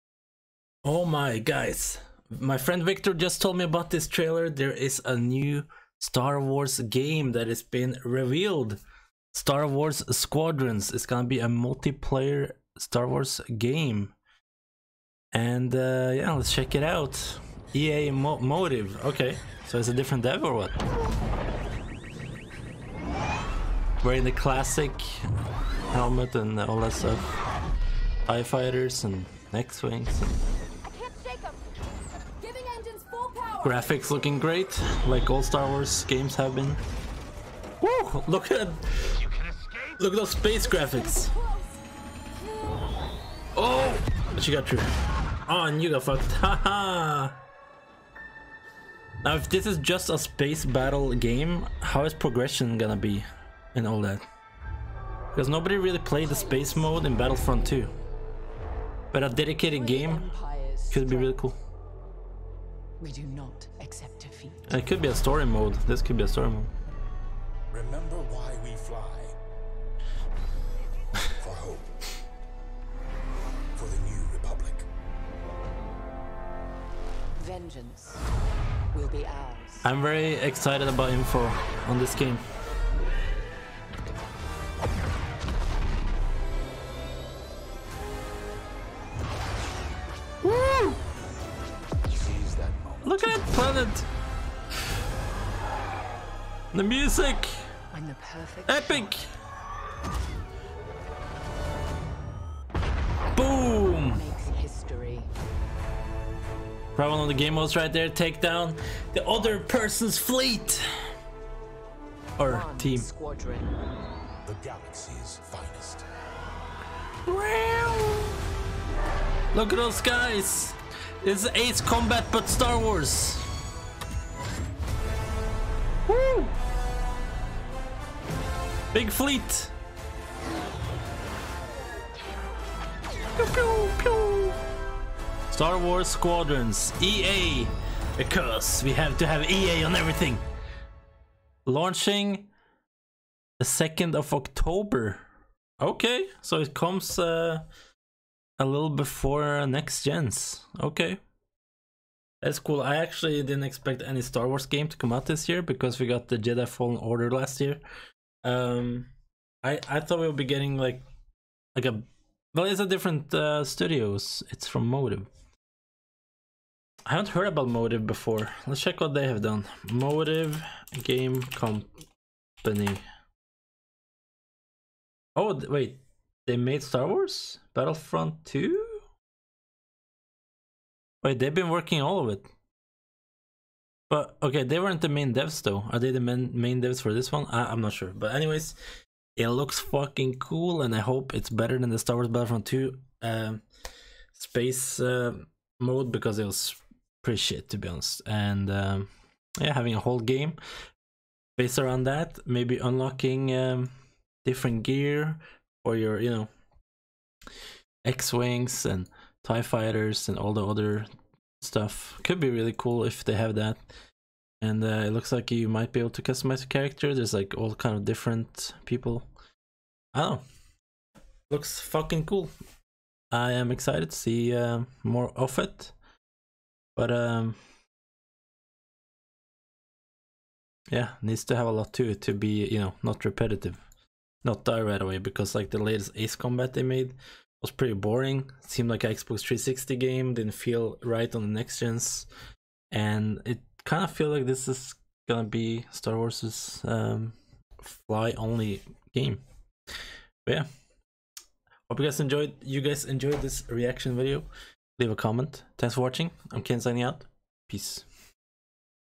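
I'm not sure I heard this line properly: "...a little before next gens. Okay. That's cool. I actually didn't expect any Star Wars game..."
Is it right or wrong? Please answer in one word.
right.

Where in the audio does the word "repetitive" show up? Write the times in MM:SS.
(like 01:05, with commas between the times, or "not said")
03:53.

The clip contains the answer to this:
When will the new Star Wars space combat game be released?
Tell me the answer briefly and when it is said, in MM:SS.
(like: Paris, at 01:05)
2 October, at 02:23.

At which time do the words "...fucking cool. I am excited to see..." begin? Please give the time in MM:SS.
03:41.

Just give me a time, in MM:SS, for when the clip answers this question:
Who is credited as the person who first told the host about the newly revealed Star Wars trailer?
00:02.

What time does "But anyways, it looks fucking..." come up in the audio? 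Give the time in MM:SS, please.
03:08.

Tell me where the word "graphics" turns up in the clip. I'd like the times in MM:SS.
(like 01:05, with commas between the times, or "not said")
00:33, 00:40.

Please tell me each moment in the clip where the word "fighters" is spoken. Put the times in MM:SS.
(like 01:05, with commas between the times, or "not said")
00:28, 03:29.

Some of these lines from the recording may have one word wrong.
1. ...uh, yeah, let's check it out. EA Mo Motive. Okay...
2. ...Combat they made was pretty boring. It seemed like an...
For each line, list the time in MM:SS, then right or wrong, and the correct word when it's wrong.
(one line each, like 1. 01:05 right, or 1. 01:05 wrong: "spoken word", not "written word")
1. 00:15 right
2. 03:56 right.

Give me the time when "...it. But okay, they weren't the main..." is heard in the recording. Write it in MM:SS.
03:02.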